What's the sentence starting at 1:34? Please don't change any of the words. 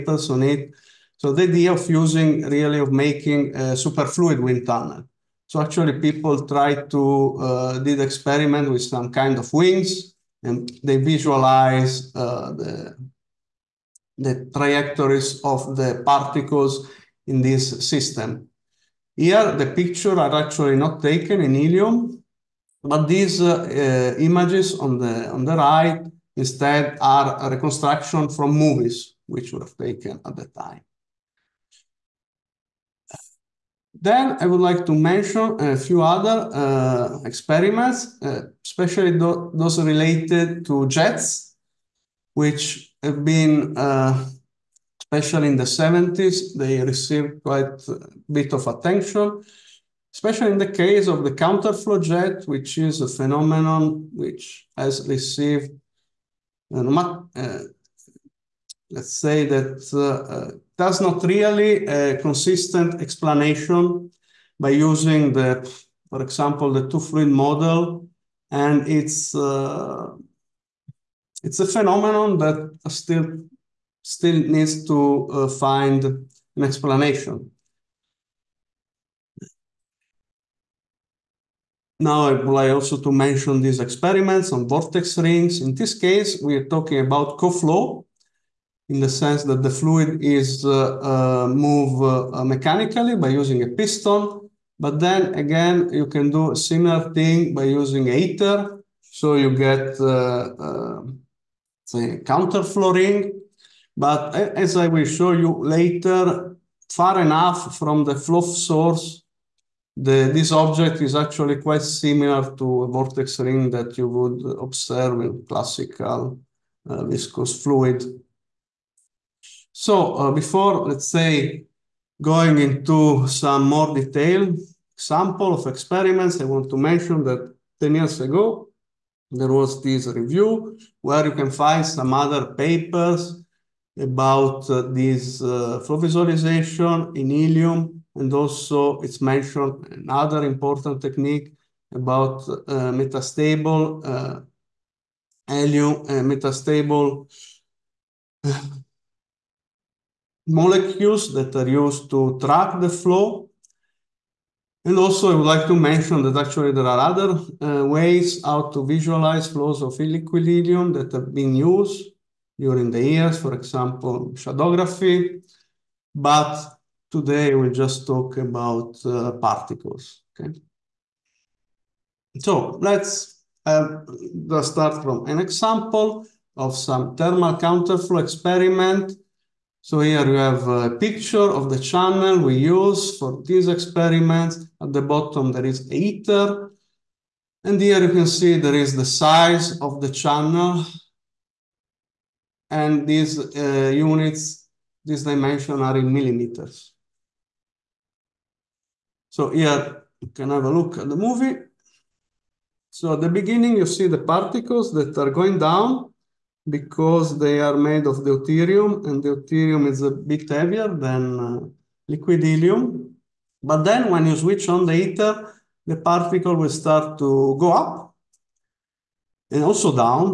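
But then again, you can do a similar thing by using a heater.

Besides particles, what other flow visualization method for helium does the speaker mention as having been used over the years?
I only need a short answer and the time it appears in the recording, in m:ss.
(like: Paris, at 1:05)
shadowgraphy, at 2:44.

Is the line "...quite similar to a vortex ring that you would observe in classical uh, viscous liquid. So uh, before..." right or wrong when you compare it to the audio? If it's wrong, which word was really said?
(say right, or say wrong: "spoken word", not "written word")
wrong: "fluid", not "liquid".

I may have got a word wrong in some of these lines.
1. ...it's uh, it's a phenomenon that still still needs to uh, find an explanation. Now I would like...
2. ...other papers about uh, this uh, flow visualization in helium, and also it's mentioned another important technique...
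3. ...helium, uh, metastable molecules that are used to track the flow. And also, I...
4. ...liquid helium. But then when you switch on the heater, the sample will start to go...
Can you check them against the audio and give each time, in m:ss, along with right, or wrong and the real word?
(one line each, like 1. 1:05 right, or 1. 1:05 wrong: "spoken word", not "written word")
1. 1:08 right
2. 2:12 right
3. 2:25 right
4. 3:32 wrong: "particle", not "sample".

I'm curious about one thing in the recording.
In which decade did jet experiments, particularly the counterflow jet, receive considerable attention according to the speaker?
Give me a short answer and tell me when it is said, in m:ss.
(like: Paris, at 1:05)
the 70s, at 0:45.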